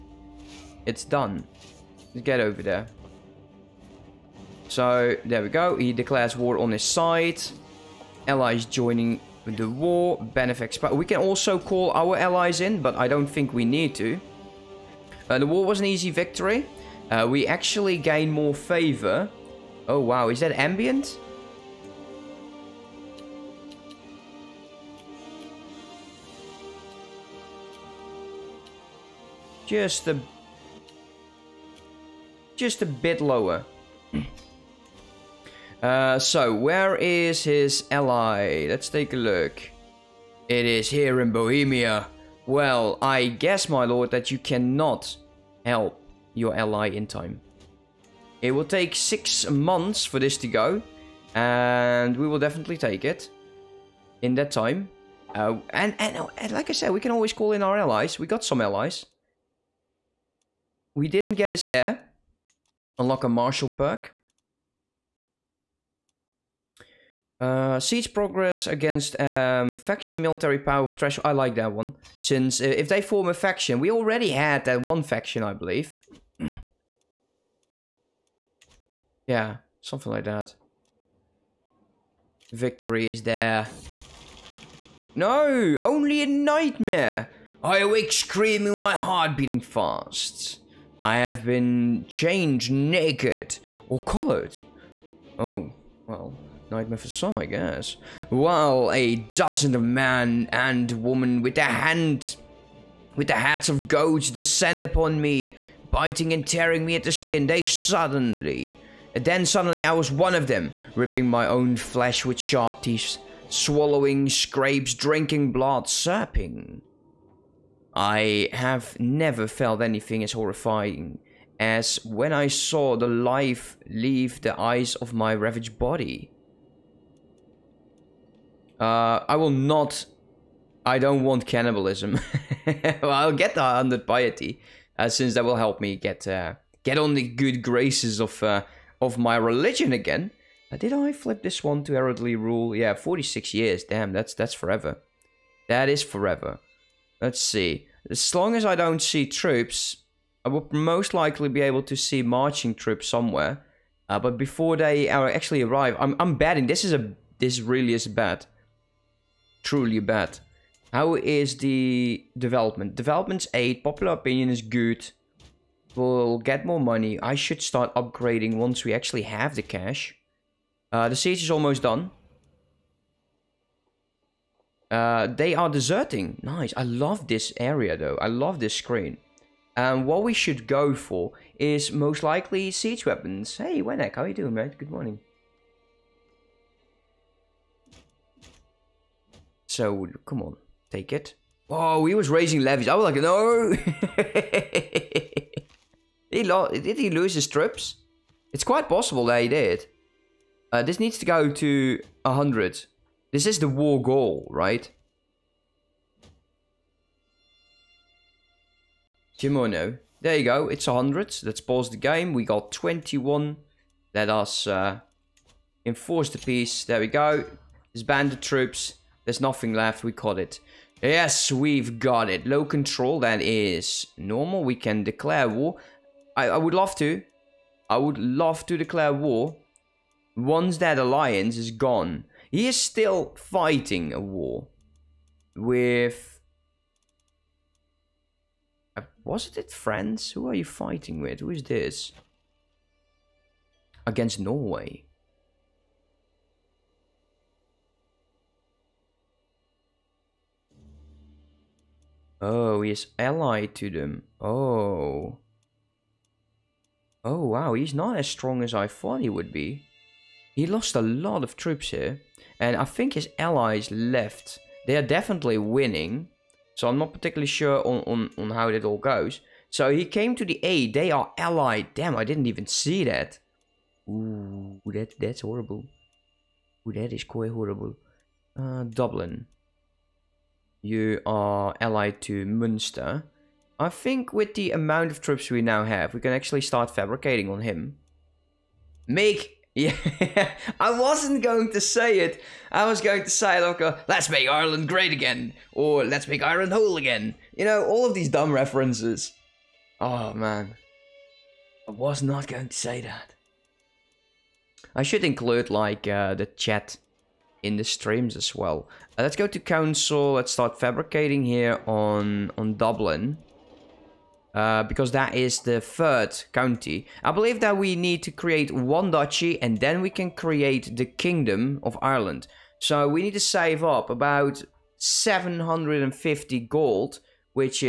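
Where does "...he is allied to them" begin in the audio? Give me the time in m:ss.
4:12.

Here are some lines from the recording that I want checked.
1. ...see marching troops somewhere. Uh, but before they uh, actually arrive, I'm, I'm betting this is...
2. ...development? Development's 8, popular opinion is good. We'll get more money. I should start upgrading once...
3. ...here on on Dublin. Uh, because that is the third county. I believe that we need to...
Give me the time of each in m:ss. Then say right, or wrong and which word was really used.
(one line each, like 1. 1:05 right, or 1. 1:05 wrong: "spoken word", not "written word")
1. 2:31 right
2. 2:42 right
3. 5:11 right.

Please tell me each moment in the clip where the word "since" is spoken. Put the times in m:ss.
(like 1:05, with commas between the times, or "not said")
1:12, 2:15.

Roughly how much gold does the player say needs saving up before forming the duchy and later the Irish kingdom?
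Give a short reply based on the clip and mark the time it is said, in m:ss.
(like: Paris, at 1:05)
750 gold, at 5:24.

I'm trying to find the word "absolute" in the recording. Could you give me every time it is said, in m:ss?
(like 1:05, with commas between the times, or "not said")
not said.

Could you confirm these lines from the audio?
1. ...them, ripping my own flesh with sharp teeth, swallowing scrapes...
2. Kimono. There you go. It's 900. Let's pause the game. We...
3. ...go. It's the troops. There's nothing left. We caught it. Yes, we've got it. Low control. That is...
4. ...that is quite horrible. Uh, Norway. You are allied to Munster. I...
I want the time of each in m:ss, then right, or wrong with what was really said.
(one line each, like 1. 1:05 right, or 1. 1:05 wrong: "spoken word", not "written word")
1. 1:50 right
2. 3:29 wrong: "100", not "900"
3. 3:37 right
4. 4:36 wrong: "Dublin", not "Norway".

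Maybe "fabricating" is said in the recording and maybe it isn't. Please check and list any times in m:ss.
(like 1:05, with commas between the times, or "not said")
4:46, 5:10.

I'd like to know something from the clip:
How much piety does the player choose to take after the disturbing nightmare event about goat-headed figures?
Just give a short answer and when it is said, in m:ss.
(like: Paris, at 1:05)
100, at 2:13.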